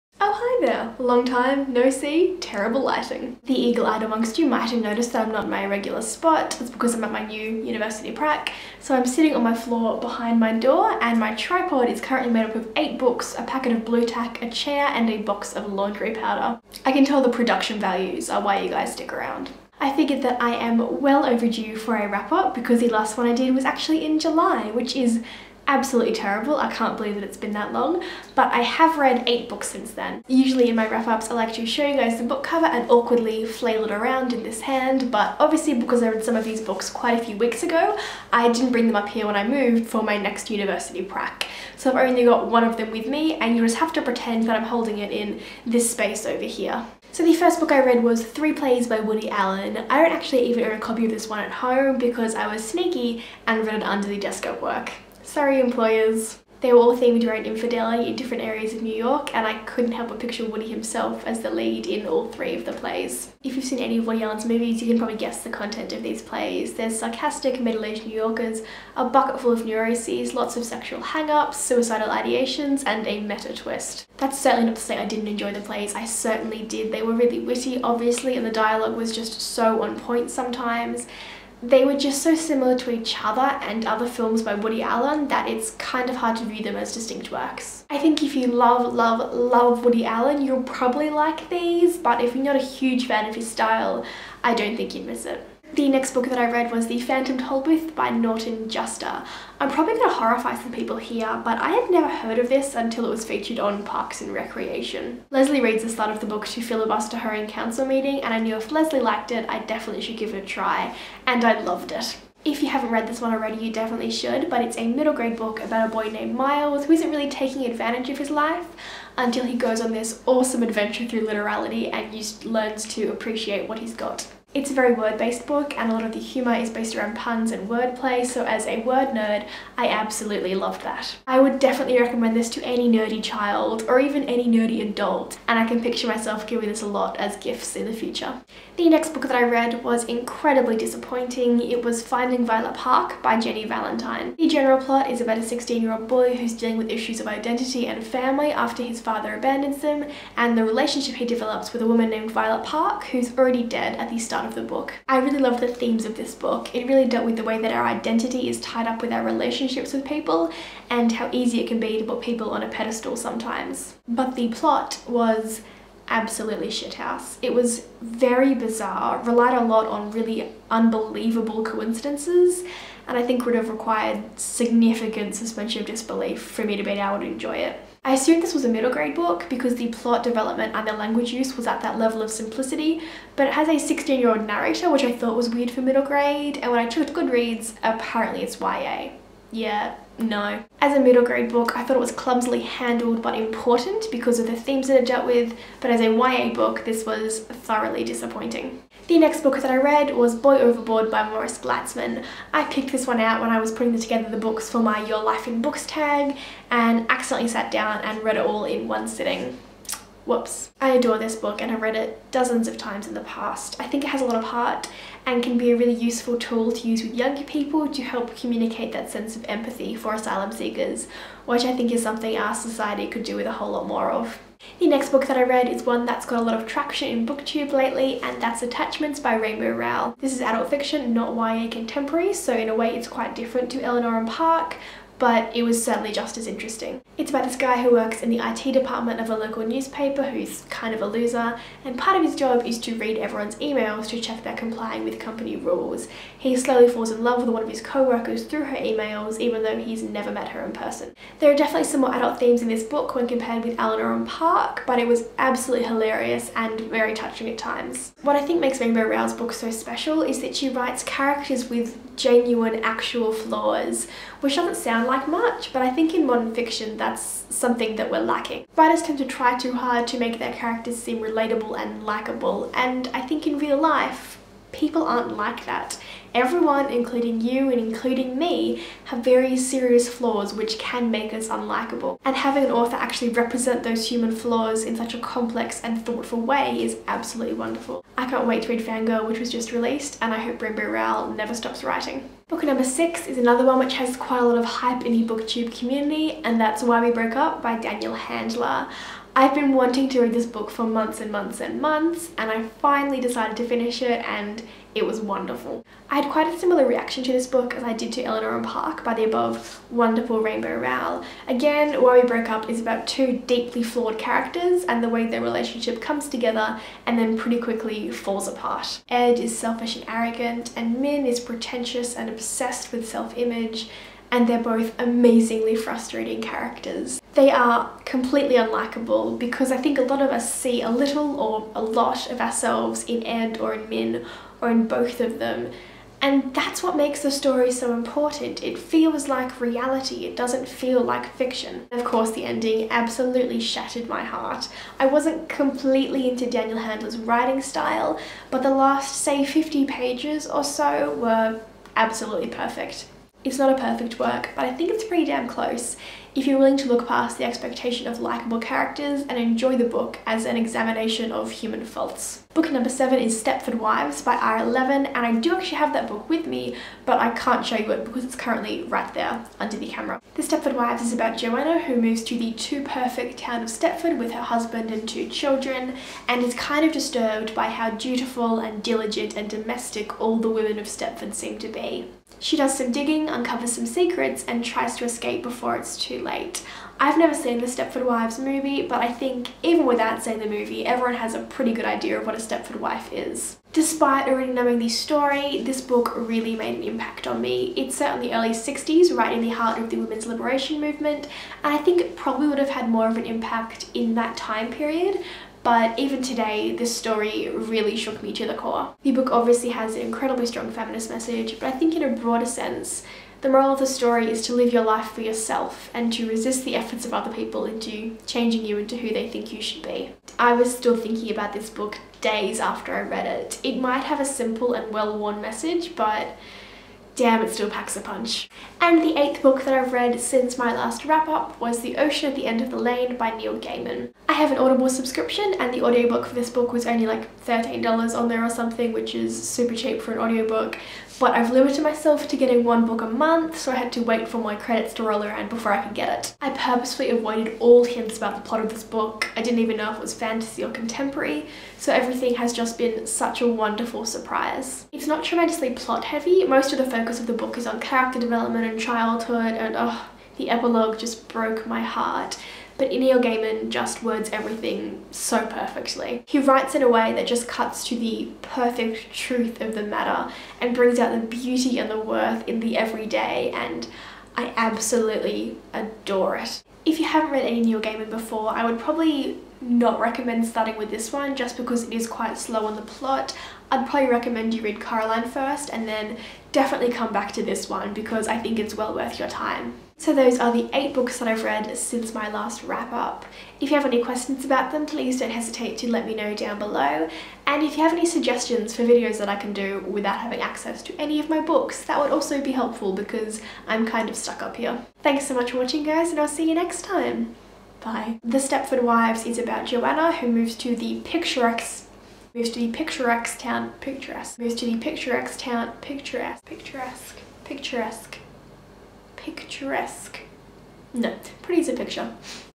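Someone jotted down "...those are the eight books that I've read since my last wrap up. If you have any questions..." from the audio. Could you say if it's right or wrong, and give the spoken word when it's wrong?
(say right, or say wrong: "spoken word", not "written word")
right.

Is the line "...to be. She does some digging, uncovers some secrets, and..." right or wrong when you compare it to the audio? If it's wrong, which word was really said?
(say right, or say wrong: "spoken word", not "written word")
right.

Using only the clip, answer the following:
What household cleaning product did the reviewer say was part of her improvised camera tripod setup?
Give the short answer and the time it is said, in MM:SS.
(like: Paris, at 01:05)
laundry powder, at 00:15.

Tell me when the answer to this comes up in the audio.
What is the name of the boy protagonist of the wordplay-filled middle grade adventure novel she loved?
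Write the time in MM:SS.
01:56.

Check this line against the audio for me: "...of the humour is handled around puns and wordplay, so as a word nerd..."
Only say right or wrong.
wrong.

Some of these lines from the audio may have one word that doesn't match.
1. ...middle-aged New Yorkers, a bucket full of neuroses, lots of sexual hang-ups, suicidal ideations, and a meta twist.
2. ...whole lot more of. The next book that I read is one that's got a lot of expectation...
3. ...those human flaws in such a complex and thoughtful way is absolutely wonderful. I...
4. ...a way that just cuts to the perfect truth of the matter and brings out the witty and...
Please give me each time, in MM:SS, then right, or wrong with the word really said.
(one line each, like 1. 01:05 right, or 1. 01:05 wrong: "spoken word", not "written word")
1. 01:07 right
2. 03:43 wrong: "traction", not "expectation"
3. 04:43 right
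4. 07:46 wrong: "beauty", not "witty".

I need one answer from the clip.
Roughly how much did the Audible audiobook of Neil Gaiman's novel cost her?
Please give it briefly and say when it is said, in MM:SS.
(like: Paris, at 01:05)
$13, at 07:17.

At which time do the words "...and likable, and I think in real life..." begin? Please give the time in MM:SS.
04:31.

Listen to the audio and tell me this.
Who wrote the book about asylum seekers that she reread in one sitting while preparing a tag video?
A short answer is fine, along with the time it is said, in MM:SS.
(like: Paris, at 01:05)
Morris Gleitzman, at 03:21.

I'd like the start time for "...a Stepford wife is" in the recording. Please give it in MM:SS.
06:32.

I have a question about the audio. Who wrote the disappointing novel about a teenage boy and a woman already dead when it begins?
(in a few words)
Jenny Valentine.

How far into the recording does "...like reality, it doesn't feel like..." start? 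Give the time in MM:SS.
05:39.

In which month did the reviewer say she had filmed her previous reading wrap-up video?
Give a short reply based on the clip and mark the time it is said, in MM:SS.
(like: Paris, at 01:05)
July, at 00:24.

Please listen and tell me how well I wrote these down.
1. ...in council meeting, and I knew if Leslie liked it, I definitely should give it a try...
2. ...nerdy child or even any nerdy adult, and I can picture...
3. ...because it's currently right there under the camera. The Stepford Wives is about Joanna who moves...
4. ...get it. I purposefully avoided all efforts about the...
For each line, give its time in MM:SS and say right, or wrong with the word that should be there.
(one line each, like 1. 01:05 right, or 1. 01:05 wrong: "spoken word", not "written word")
1. 01:47 right
2. 02:12 right
3. 06:08 right
4. 07:25 wrong: "hints", not "efforts".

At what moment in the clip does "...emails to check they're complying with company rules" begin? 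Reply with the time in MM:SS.
04:03.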